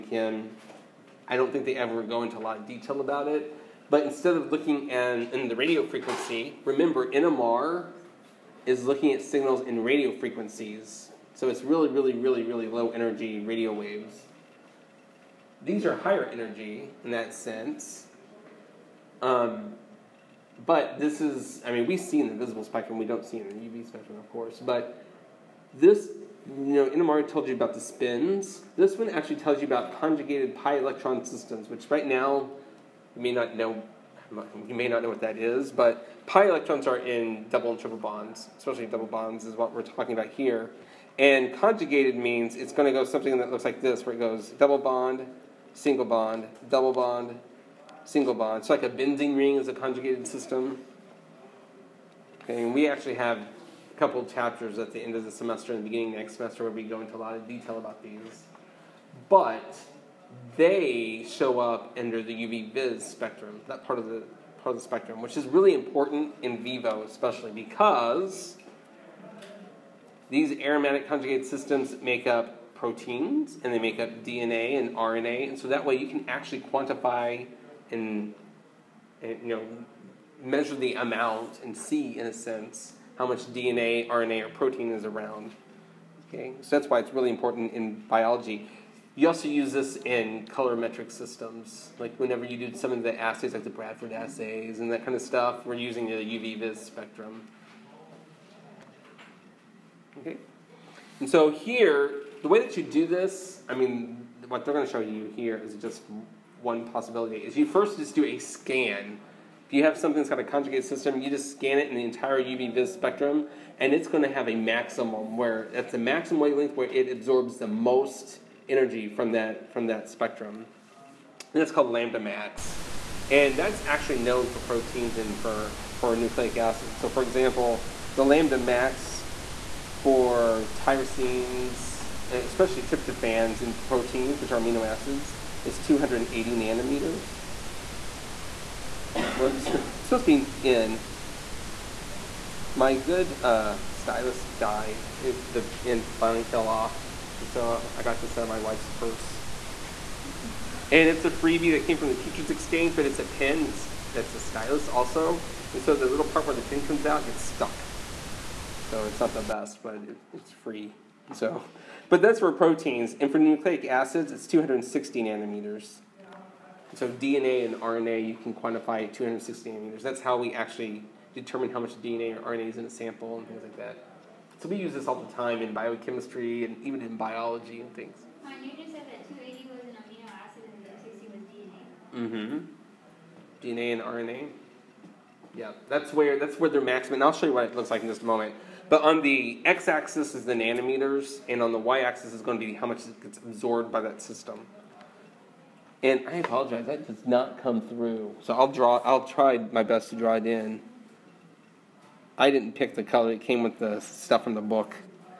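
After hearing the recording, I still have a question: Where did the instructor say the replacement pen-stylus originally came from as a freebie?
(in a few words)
the Teachers Exchange.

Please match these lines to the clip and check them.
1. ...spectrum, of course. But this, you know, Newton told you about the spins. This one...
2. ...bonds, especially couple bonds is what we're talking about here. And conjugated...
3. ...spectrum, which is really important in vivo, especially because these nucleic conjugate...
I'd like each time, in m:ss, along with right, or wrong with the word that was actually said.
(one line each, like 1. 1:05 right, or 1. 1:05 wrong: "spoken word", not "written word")
1. 0:23 wrong: "NMR", not "Newton"
2. 0:37 wrong: "double", not "couple"
3. 1:04 wrong: "aromatic", not "nucleic".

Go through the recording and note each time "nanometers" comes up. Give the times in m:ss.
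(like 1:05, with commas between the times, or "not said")
2:16, 2:45, 2:49, 3:10.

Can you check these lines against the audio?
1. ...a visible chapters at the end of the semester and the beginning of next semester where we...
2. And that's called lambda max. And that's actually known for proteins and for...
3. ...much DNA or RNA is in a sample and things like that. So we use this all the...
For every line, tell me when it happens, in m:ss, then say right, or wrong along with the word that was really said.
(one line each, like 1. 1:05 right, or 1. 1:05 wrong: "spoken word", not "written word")
1. 0:53 wrong: "couple", not "visible"
2. 2:01 right
3. 2:51 right.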